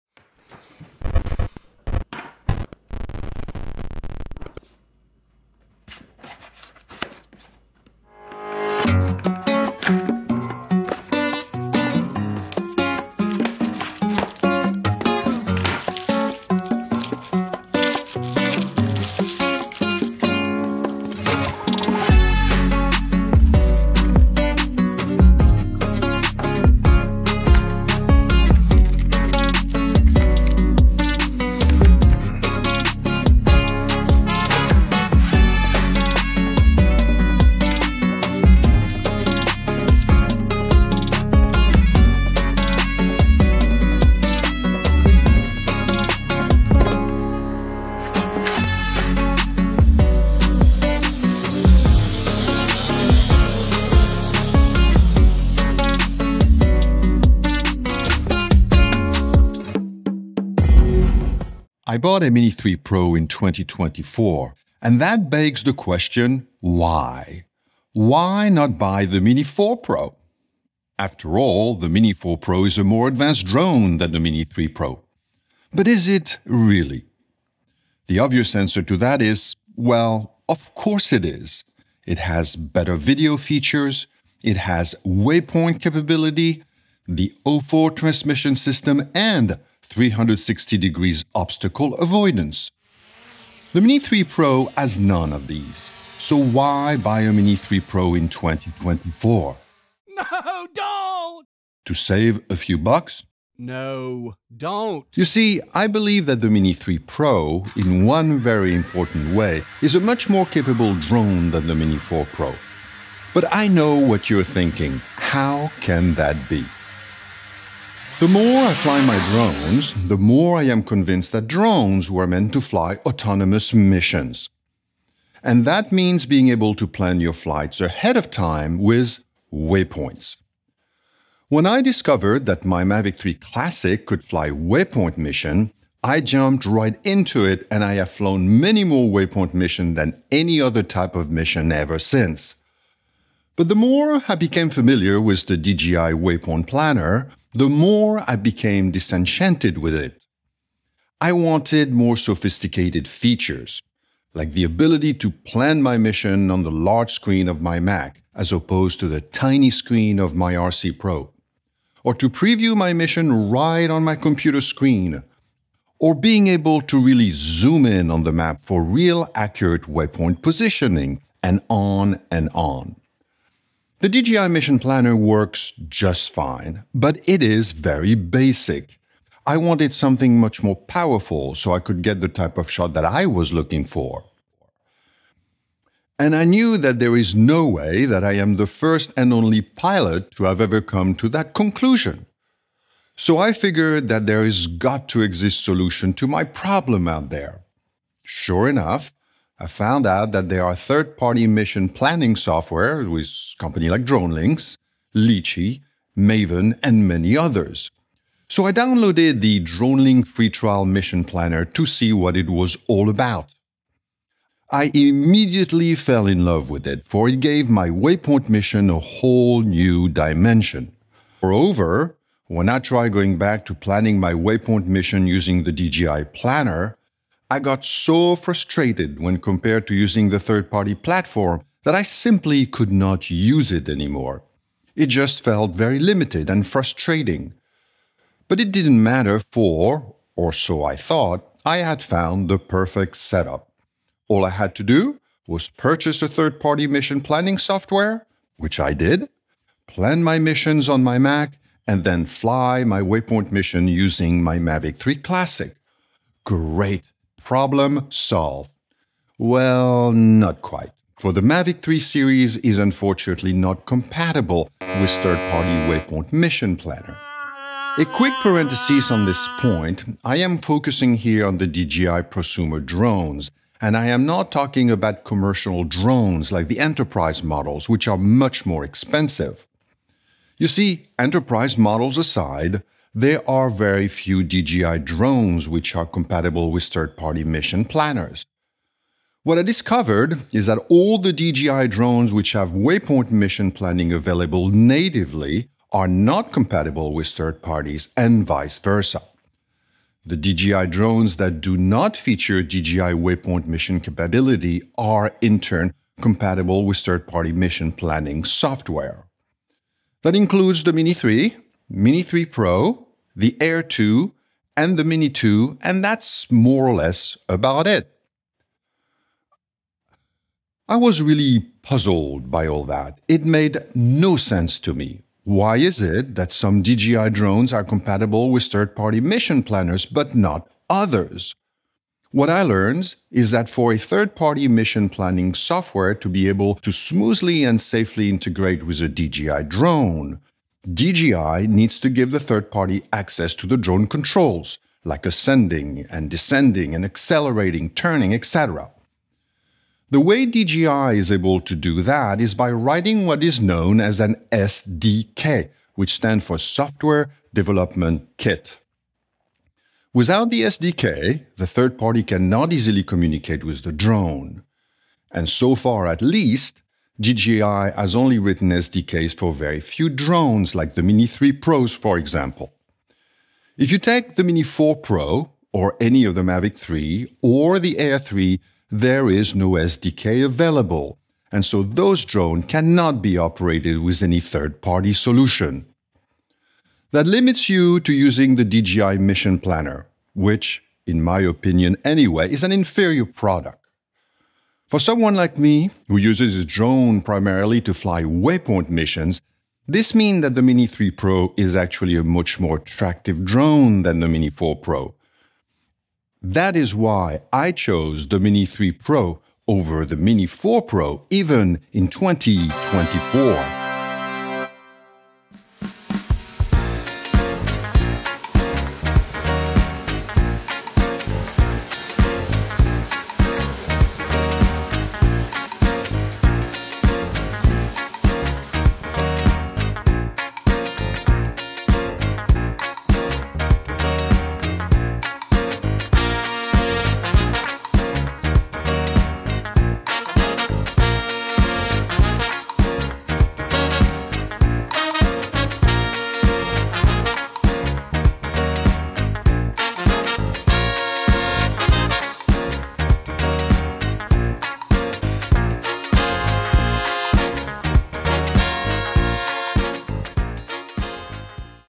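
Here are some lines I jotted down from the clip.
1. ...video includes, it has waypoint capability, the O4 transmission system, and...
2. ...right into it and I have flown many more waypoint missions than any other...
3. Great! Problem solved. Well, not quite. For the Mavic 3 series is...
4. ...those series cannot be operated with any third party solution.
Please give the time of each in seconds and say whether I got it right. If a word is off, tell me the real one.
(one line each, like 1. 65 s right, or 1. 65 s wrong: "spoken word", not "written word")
1. 82 s wrong: "features", not "includes"
2. 136 s right
3. 256 s right
4. 381 s wrong: "drones", not "series".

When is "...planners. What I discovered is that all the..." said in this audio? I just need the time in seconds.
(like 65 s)
287 s.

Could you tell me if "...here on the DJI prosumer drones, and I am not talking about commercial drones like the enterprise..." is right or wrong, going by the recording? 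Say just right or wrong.
right.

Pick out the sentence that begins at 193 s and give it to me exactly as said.
So I figured that there has got to exist solution to my problem out there.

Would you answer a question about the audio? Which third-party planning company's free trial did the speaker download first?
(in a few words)
DroneLink.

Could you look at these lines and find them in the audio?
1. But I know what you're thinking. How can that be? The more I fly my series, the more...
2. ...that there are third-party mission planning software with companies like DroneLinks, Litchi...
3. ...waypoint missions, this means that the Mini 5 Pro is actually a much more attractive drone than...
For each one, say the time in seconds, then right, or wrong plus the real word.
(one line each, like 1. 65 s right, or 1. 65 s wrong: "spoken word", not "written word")
1. 113 s wrong: "drones", not "series"
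2. 200 s right
3. 398 s wrong: "3", not "5".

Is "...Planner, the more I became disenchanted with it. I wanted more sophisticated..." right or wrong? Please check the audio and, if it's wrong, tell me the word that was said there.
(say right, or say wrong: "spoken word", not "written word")
right.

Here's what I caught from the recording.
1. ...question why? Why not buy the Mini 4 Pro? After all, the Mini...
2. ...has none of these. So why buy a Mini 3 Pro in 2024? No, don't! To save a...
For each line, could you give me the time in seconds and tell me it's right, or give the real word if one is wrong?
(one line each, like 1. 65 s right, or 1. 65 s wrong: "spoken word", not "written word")
1. 65 s right
2. 94 s right.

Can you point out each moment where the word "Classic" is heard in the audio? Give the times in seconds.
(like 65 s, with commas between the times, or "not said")
133 s, 255 s.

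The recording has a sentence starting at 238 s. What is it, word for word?
But it didn't matter, for, or so I thought, I had found the perfect setup.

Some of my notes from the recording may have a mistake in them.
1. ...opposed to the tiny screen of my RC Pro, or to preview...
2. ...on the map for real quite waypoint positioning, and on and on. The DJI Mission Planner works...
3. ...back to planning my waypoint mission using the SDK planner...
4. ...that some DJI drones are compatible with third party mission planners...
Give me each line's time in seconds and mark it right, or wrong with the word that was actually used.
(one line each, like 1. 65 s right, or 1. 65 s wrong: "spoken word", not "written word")
1. 158 s right
2. 168 s wrong: "accurate", not "quite"
3. 223 s wrong: "DJI", not "SDK"
4. 326 s right.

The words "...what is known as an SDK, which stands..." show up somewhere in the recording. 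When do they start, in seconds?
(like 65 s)
353 s.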